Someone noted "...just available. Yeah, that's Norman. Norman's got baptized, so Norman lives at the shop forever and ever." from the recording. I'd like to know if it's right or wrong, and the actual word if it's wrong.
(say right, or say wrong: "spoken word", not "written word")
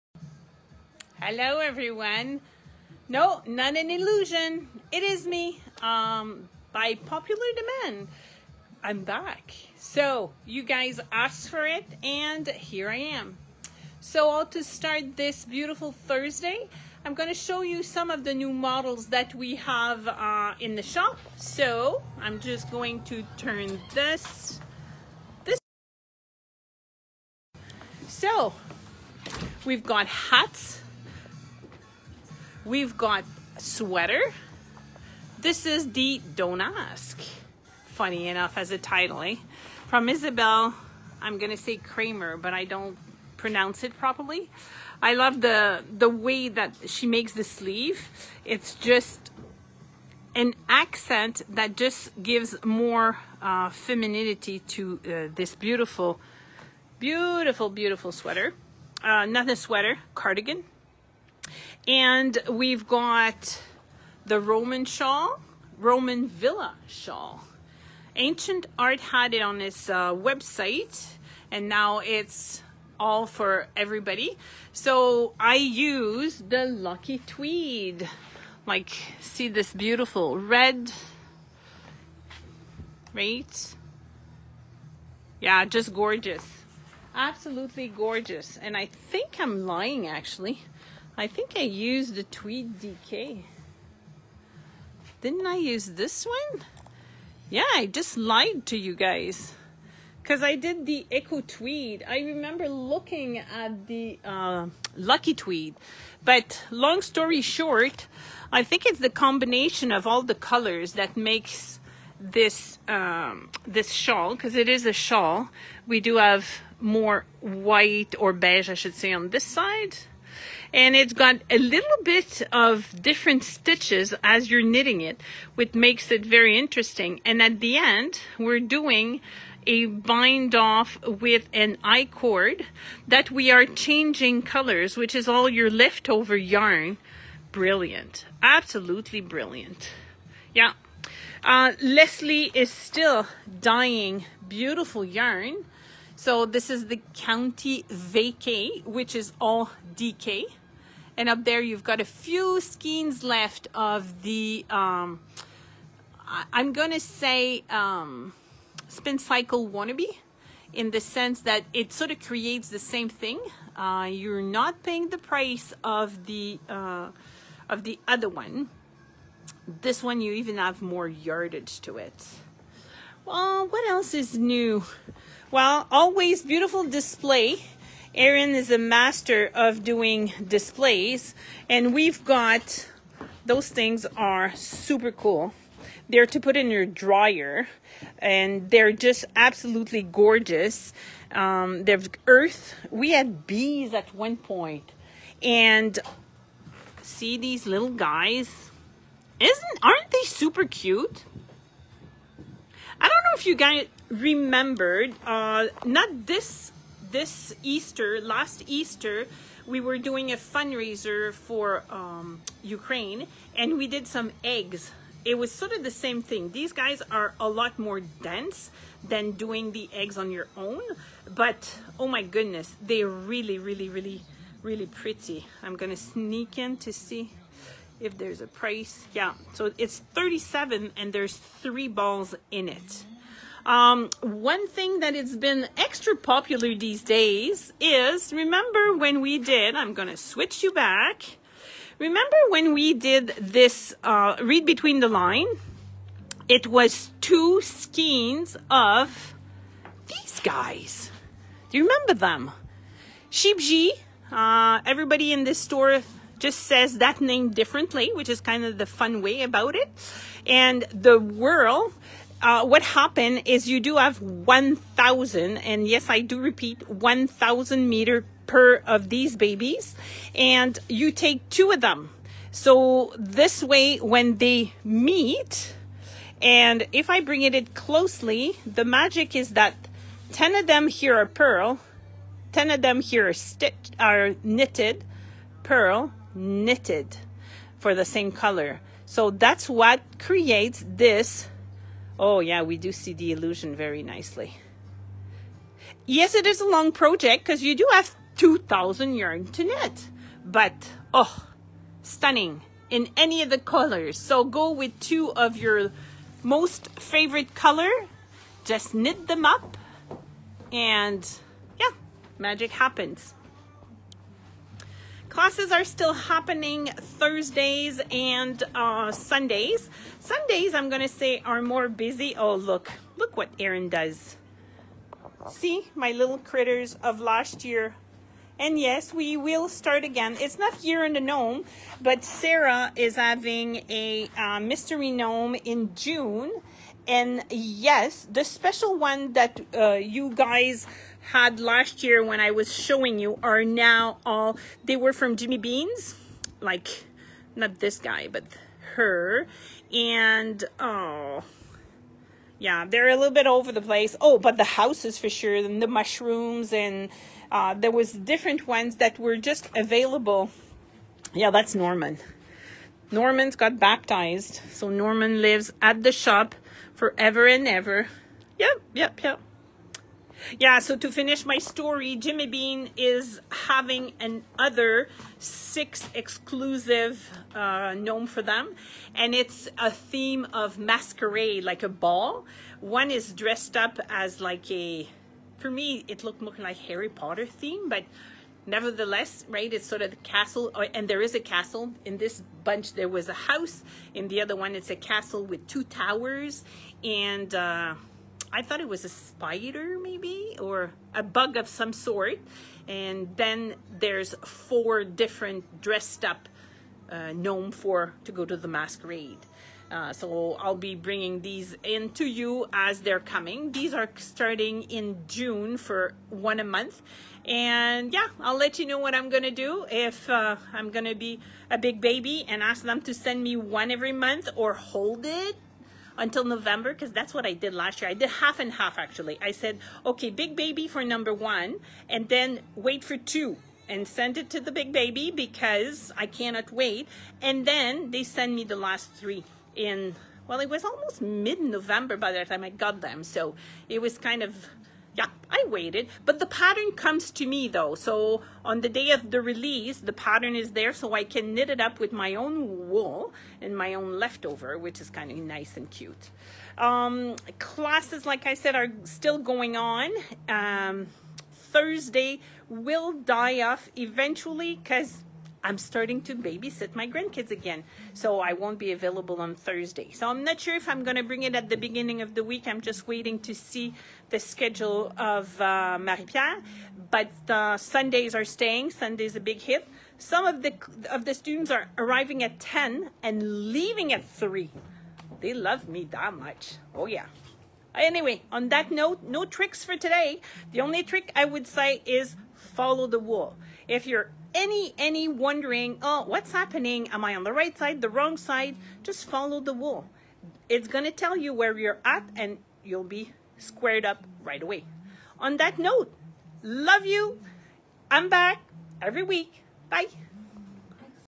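right.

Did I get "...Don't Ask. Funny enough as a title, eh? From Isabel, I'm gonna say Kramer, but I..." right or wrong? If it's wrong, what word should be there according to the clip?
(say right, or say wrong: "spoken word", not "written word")
right.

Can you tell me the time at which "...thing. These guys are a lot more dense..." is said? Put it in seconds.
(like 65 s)
216 s.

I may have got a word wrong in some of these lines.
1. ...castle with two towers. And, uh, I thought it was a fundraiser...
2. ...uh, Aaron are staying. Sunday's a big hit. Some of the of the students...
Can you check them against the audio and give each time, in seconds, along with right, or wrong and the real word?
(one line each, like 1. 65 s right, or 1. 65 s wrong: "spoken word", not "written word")
1. 394 s wrong: "spider", not "fundraiser"
2. 477 s wrong: "Sundays", not "Aaron".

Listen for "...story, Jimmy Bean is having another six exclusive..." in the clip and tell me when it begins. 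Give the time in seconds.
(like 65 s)
371 s.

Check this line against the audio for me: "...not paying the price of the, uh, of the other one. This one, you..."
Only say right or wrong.
right.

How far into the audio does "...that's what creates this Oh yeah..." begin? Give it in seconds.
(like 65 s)
289 s.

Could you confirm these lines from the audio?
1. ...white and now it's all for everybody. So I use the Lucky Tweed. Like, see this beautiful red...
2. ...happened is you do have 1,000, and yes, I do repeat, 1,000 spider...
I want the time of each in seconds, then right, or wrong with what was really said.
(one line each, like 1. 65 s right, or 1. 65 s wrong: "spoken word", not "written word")
1. 70 s wrong: "website", not "white"
2. 262 s wrong: "meter", not "spider".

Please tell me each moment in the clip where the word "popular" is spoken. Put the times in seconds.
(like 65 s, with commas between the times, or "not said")
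6 s, 236 s.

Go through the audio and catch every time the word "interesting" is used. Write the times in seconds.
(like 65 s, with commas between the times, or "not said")
126 s.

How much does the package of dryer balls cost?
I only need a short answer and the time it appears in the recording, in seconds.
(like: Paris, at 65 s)
37, at 229 s.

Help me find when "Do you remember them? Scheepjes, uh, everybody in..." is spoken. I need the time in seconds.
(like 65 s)
251 s.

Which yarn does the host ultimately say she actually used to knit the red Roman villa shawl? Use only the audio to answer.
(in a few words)
Echo Tweed.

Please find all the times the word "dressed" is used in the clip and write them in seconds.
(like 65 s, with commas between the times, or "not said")
383 s, 405 s.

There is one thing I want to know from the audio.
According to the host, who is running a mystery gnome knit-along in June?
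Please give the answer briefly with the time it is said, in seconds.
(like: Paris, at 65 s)
Sarah, at 332 s.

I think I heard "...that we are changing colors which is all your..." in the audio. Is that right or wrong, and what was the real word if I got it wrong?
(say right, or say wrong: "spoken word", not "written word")
right.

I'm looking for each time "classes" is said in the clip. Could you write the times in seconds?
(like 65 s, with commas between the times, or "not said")
315 s, 457 s.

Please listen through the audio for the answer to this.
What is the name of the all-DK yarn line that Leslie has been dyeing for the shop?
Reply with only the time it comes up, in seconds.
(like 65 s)
147 s.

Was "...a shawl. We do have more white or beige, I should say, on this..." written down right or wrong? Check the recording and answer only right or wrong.
right.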